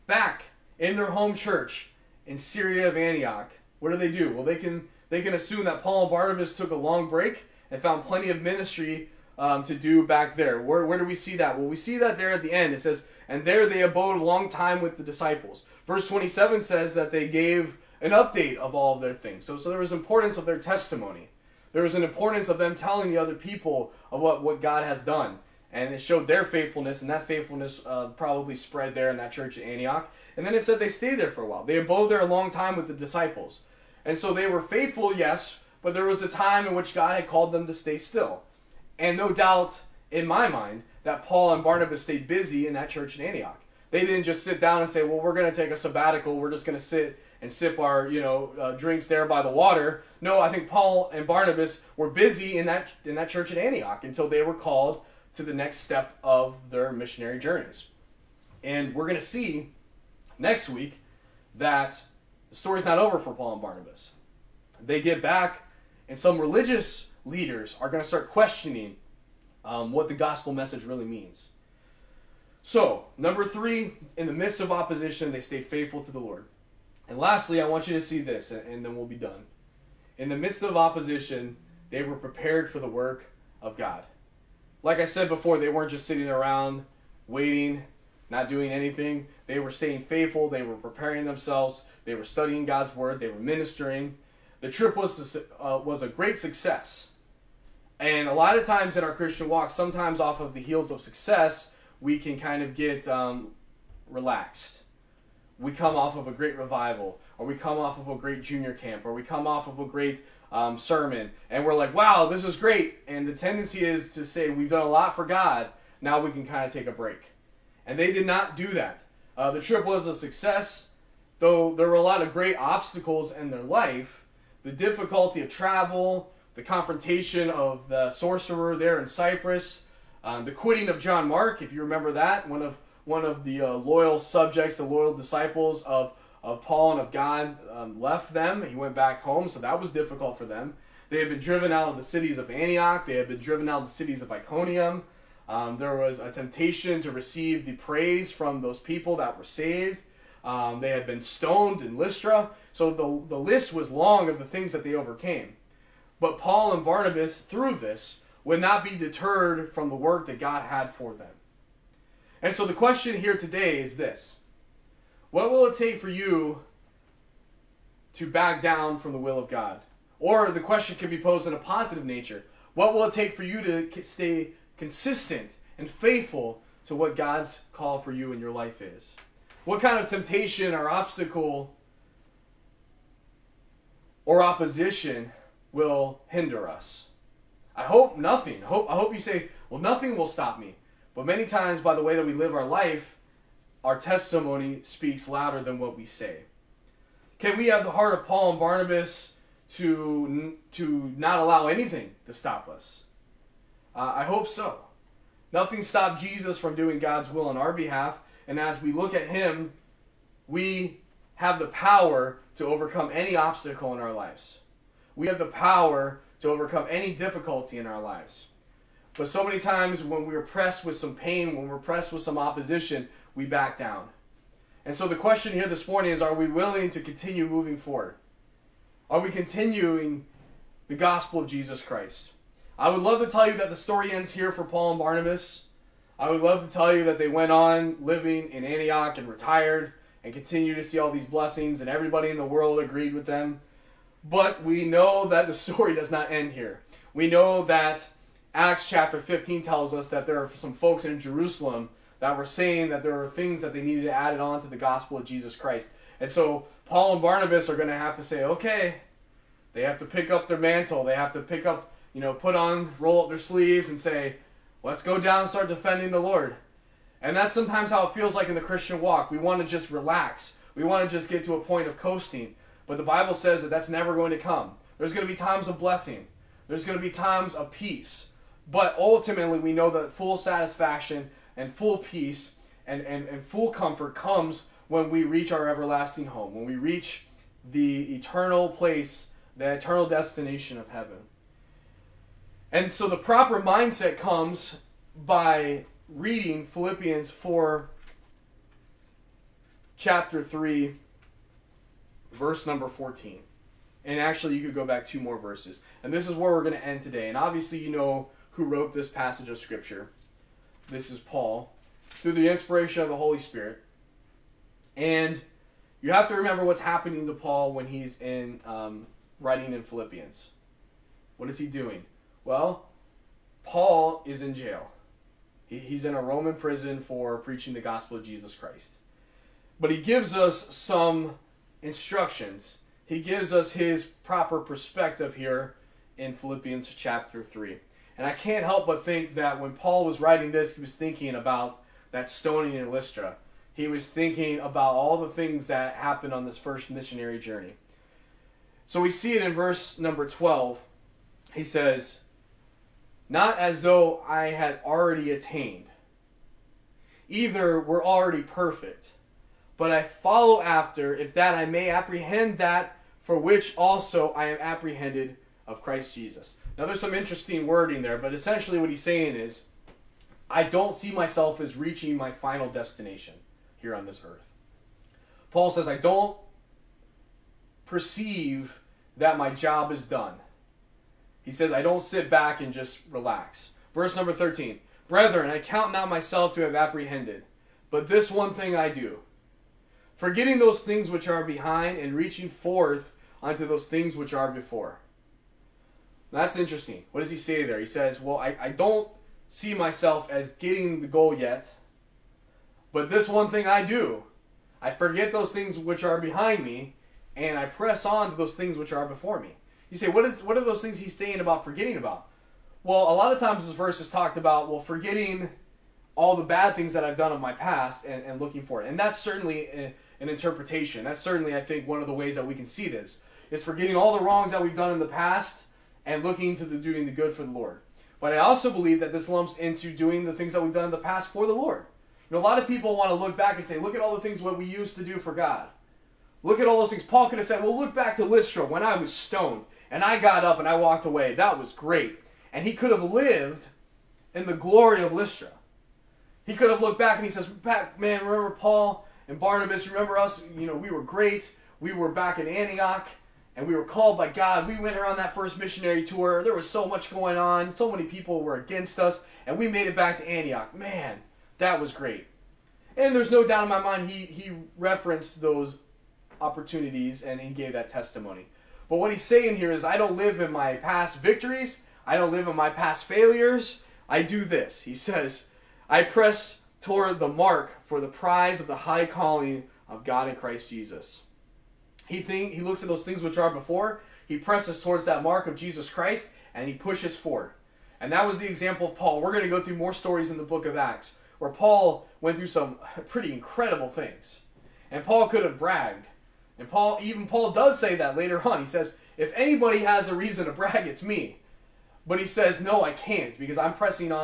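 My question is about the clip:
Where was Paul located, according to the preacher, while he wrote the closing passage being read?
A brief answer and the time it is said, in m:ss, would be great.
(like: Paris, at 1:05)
A Roman prison, at 5:26.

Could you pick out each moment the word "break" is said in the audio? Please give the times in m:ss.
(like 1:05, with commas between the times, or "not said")
0:07, 1:56.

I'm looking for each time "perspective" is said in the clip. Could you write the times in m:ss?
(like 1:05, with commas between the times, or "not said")
5:34.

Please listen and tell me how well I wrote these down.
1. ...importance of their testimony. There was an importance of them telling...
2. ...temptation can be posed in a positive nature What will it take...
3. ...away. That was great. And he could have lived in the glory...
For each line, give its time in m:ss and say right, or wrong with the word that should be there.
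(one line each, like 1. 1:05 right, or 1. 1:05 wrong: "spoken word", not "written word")
1. 0:19 right
2. 2:50 wrong: "question", not "temptation"
3. 7:21 right.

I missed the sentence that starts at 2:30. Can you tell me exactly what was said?
Um, they had been stoned in Lystra.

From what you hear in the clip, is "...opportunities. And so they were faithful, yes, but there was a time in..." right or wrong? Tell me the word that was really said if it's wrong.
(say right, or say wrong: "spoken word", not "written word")
wrong: "disciples", not "opportunities".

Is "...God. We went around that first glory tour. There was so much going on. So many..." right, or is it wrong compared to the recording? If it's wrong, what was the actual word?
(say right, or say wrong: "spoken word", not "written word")
wrong: "missionary", not "glory".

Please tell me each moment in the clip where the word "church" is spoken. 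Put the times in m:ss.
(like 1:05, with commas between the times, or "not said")
0:01, 0:29, 0:42, 0:53.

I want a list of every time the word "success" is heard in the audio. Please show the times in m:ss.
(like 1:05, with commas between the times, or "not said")
1:36, 1:40, 2:00.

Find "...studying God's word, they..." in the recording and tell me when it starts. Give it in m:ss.
1:32.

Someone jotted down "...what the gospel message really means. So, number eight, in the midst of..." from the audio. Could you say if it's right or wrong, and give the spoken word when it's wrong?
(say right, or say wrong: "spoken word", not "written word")
wrong: "three", not "eight".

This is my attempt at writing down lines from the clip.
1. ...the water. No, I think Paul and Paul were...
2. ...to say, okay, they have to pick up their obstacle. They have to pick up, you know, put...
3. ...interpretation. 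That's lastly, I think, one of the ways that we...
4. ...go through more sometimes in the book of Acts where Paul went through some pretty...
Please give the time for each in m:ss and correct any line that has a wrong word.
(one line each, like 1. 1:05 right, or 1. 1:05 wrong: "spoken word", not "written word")
1. 0:49 wrong: "Barnabas", not "Paul"
2. 4:18 wrong: "mantle", not "obstacle"
3. 7:00 wrong: "certainly", not "lastly"
4. 8:09 wrong: "stories", not "sometimes".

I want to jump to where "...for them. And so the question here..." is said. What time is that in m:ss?
2:40.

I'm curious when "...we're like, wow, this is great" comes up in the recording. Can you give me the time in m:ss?
1:51.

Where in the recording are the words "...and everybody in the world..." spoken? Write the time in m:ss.
4:01.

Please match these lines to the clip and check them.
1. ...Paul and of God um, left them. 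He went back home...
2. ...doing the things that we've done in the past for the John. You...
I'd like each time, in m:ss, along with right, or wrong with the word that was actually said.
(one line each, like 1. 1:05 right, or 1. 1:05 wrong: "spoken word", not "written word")
1. 2:16 right
2. 7:09 wrong: "Lord", not "John".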